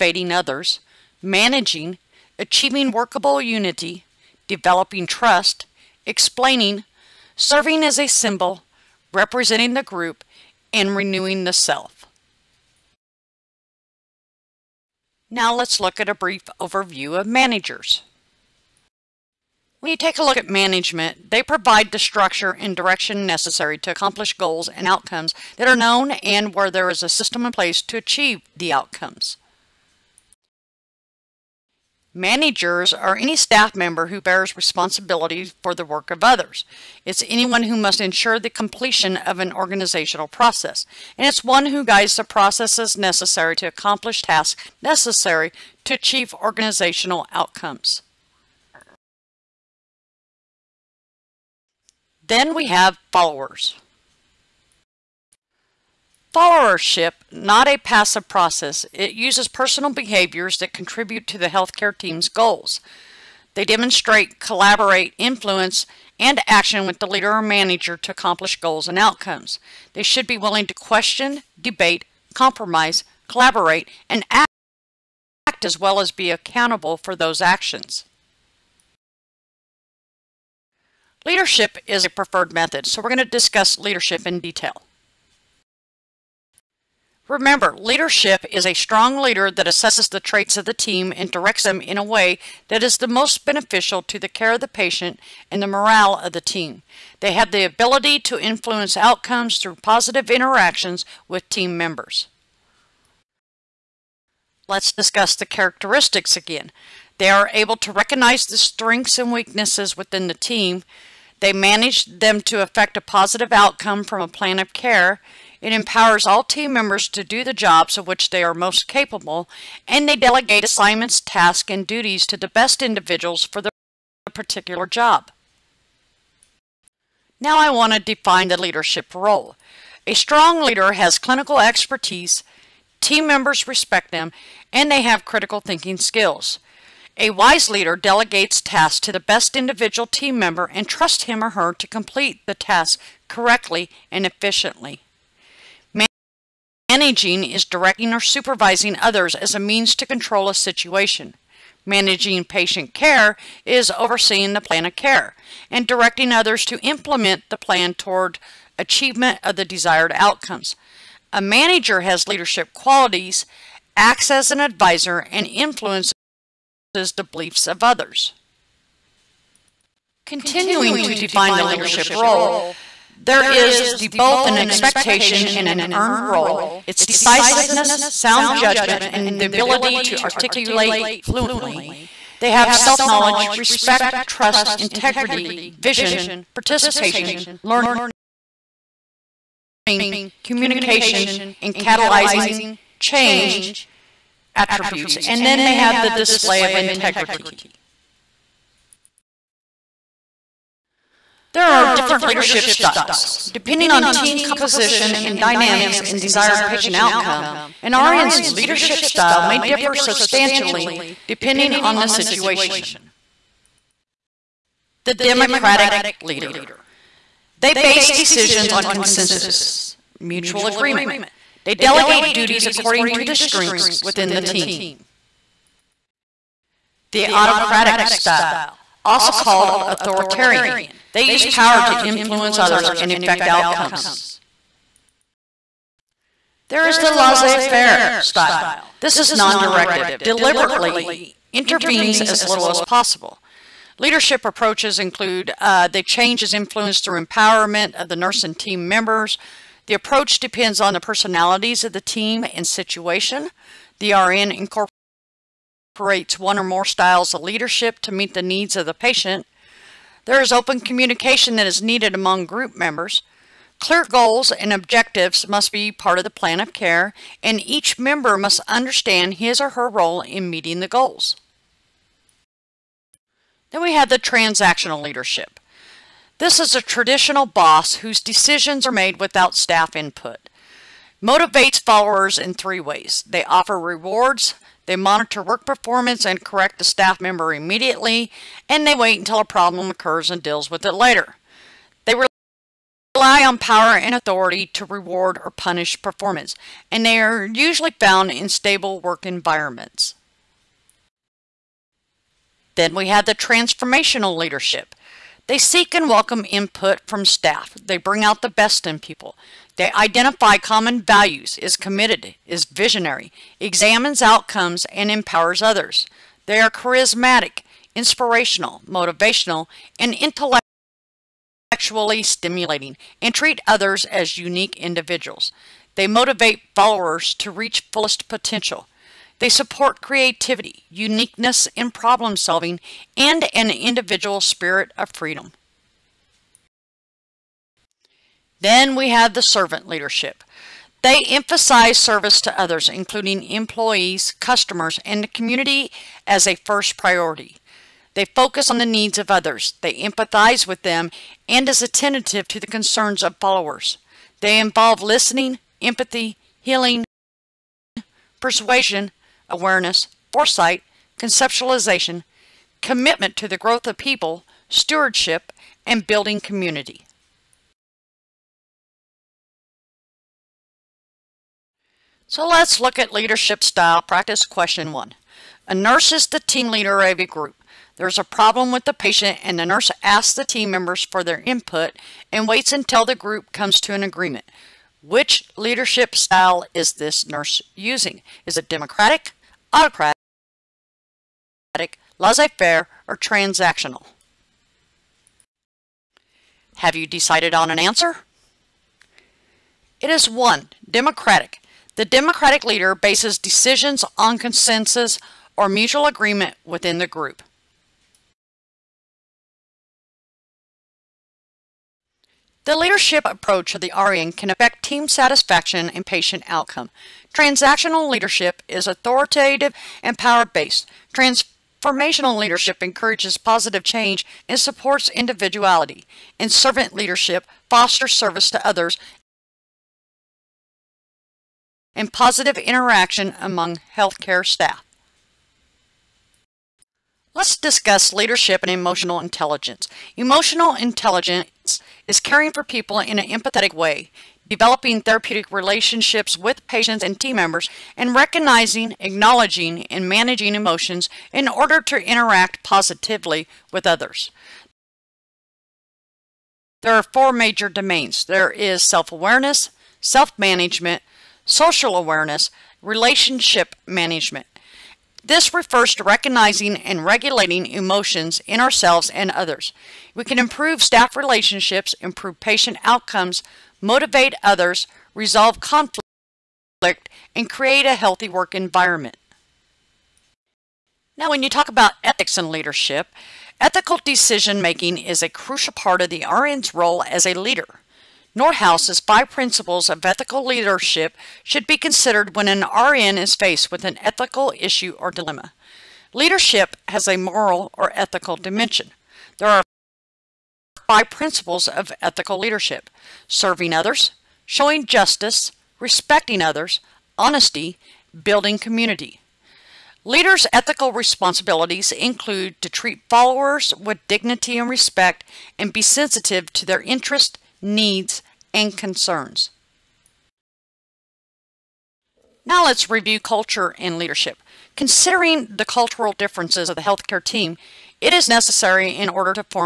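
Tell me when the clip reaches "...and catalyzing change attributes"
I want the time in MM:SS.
03:11.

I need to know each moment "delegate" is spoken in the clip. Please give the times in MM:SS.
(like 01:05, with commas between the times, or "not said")
02:00, 02:17, 03:41.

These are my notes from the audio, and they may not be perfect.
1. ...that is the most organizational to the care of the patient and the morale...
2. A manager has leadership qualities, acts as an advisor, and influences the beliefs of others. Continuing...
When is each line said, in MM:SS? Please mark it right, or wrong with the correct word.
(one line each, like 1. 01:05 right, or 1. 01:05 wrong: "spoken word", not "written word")
1. 01:32 wrong: "beneficial", not "organizational"
2. 02:41 right.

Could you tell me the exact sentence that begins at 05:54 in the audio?
They involve listening, empathy, healing, persuasion, awareness, foresight, conceptualization, commitment to the growth of people, stewardship, and building community.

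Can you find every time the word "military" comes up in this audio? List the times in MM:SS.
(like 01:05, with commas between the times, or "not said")
not said.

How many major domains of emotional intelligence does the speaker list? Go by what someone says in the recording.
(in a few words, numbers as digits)
4.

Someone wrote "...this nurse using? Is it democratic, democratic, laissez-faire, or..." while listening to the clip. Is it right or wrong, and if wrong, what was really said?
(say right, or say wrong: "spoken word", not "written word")
wrong: "autocratic", not "democratic".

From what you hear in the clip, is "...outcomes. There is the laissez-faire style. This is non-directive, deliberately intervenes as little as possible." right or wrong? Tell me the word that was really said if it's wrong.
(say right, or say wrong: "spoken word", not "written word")
right.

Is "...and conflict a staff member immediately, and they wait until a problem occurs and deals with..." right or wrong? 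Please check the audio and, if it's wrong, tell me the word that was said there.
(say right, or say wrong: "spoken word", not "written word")
wrong: "correct", not "conflict".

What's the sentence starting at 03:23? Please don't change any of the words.
Depending on team composition and dynamics and desired patient outcome, an RN's leadership style may differ substantially depending on the situation.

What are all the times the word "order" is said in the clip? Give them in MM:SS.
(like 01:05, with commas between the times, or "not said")
07:31, 08:49.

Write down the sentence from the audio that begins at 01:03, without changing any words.
They demonstrate, collaborate, influence, and action with the leader or manager to accomplish goals and outcomes.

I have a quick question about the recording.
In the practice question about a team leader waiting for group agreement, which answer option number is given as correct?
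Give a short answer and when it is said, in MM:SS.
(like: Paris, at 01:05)
1, at 06:40.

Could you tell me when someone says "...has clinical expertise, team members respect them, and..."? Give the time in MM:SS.
02:10.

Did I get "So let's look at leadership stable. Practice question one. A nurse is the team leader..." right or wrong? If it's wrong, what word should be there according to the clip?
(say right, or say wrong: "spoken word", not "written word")
wrong: "style", not "stable".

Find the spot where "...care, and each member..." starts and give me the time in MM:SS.
04:26.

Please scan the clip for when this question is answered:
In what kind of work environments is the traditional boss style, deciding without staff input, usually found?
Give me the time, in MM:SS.
04:58.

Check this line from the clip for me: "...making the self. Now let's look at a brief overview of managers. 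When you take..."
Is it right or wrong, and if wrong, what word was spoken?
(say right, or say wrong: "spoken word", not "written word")
wrong: "renewing", not "making".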